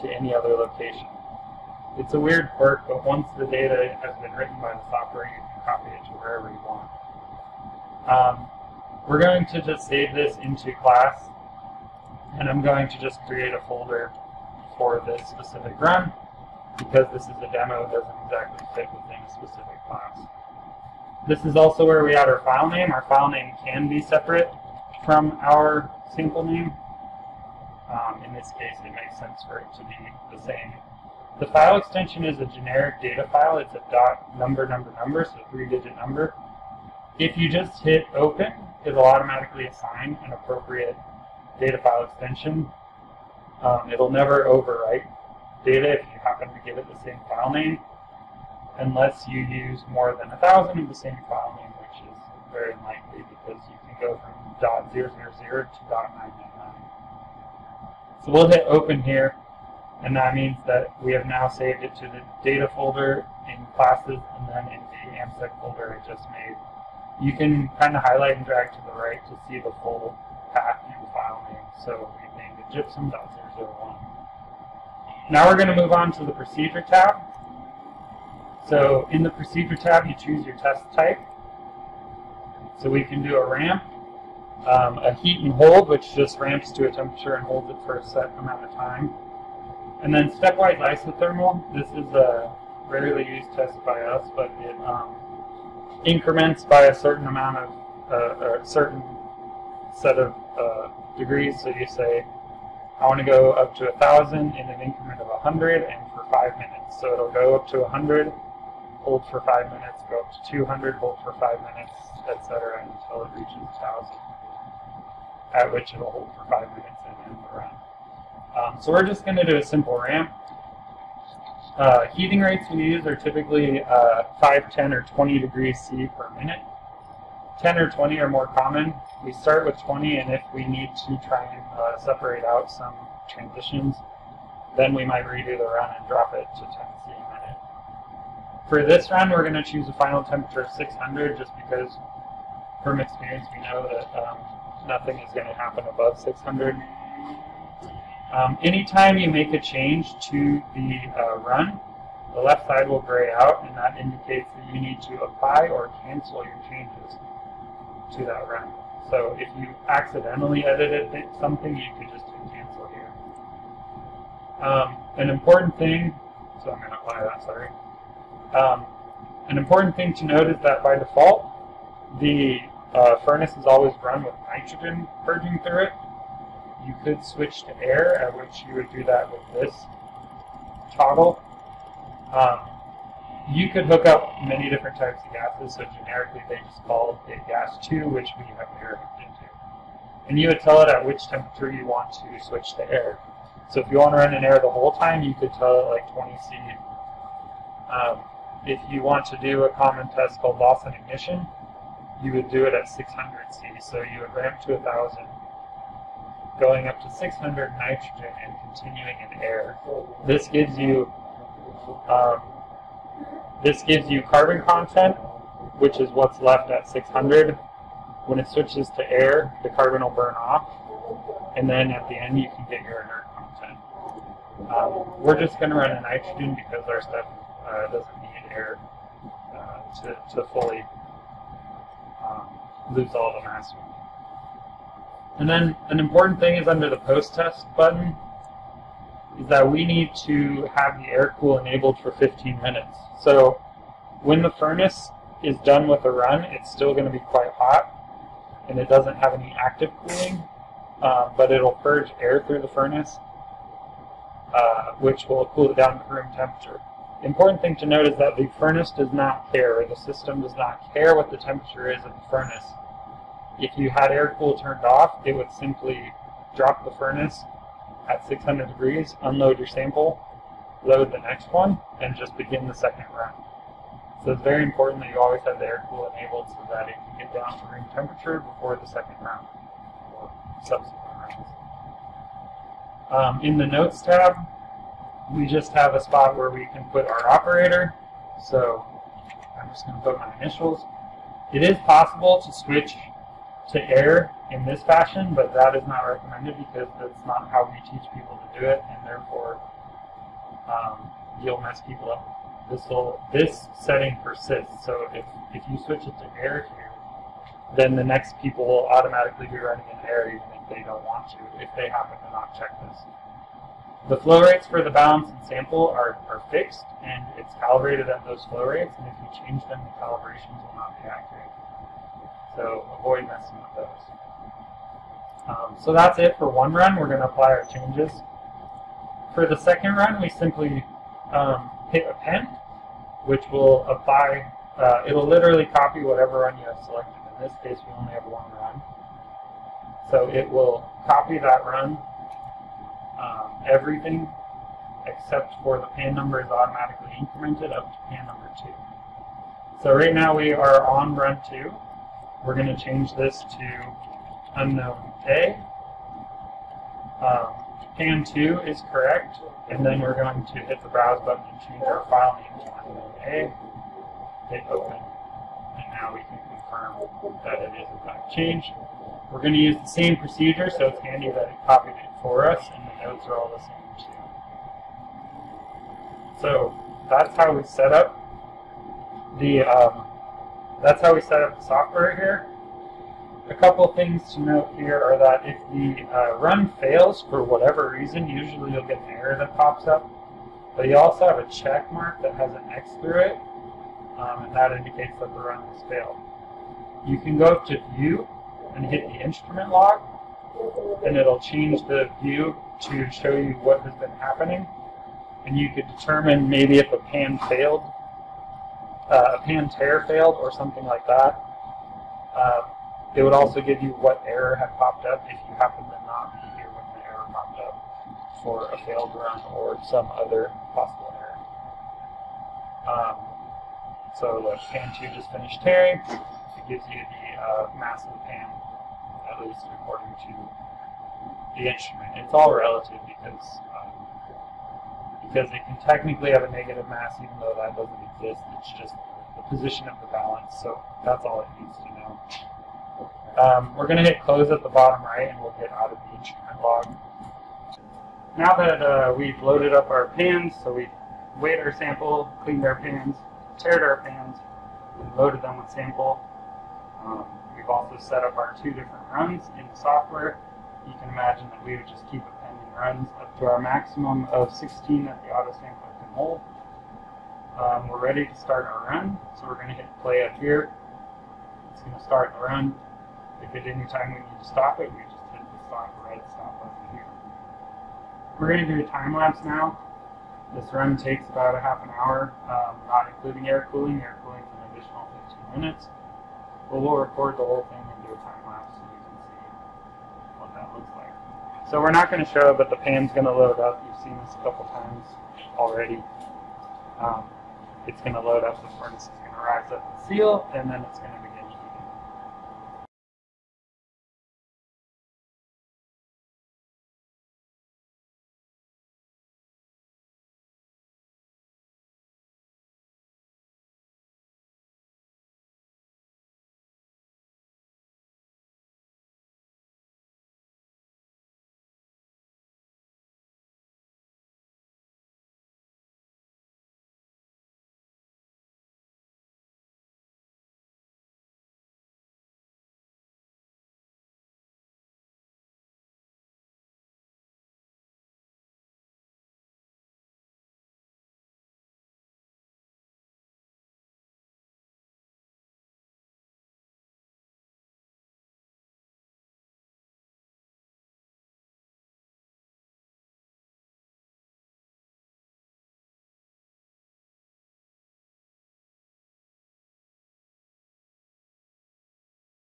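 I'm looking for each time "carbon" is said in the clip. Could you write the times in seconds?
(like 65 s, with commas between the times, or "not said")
214 s, 219 s.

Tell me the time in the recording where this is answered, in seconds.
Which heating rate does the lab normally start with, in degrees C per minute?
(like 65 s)
129 s.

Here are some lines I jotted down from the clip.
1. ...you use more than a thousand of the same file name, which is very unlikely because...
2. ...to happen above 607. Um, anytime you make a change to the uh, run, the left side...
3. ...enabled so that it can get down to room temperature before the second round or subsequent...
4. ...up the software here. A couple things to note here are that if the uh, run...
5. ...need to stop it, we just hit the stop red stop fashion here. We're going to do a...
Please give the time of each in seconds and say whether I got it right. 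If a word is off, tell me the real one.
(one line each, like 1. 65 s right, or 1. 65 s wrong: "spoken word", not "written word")
1. 49 s right
2. 145 s wrong: "600", not "607"
3. 276 s right
4. 381 s right
5. 474 s wrong: "button", not "fashion".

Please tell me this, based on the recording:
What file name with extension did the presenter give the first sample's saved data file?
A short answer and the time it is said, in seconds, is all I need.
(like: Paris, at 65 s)
gypsum.001, at 72 s.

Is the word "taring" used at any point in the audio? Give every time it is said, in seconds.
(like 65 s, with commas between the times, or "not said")
425 s.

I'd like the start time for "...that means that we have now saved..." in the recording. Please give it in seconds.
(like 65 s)
60 s.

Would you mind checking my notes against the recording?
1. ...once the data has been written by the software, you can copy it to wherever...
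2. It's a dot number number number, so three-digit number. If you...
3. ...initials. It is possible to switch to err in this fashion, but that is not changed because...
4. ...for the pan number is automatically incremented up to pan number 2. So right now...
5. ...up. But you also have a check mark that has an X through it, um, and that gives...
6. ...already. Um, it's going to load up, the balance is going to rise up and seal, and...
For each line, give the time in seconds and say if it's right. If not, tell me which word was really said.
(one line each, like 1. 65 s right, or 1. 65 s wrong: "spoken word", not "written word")
1. 3 s right
2. 33 s right
3. 290 s wrong: "recommended", not "changed"
4. 345 s right
5. 389 s wrong: "indicates", not "gives"
6. 495 s wrong: "furnace", not "balance".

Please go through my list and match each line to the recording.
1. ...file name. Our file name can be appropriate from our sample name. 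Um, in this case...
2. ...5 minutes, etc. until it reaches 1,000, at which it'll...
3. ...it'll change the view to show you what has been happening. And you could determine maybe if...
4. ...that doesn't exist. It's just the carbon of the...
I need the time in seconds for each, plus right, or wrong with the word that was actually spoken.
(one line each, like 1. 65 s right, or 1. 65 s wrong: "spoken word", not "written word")
1. 22 s wrong: "separate", not "appropriate"
2. 111 s right
3. 401 s right
4. 437 s wrong: "position", not "carbon".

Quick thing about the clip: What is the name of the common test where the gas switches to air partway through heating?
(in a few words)
loss on ignition.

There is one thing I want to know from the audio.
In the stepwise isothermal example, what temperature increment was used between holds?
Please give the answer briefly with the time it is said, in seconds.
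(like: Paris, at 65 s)
100, at 104 s.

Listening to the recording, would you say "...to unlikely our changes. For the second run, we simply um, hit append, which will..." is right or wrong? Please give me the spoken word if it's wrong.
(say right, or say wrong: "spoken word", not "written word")
wrong: "apply", not "unlikely".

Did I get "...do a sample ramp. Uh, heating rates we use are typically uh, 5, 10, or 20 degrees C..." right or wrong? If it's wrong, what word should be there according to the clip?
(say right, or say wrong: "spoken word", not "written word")
wrong: "simple", not "sample".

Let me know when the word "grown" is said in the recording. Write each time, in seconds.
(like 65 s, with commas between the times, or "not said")
not said.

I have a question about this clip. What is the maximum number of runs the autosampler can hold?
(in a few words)
16.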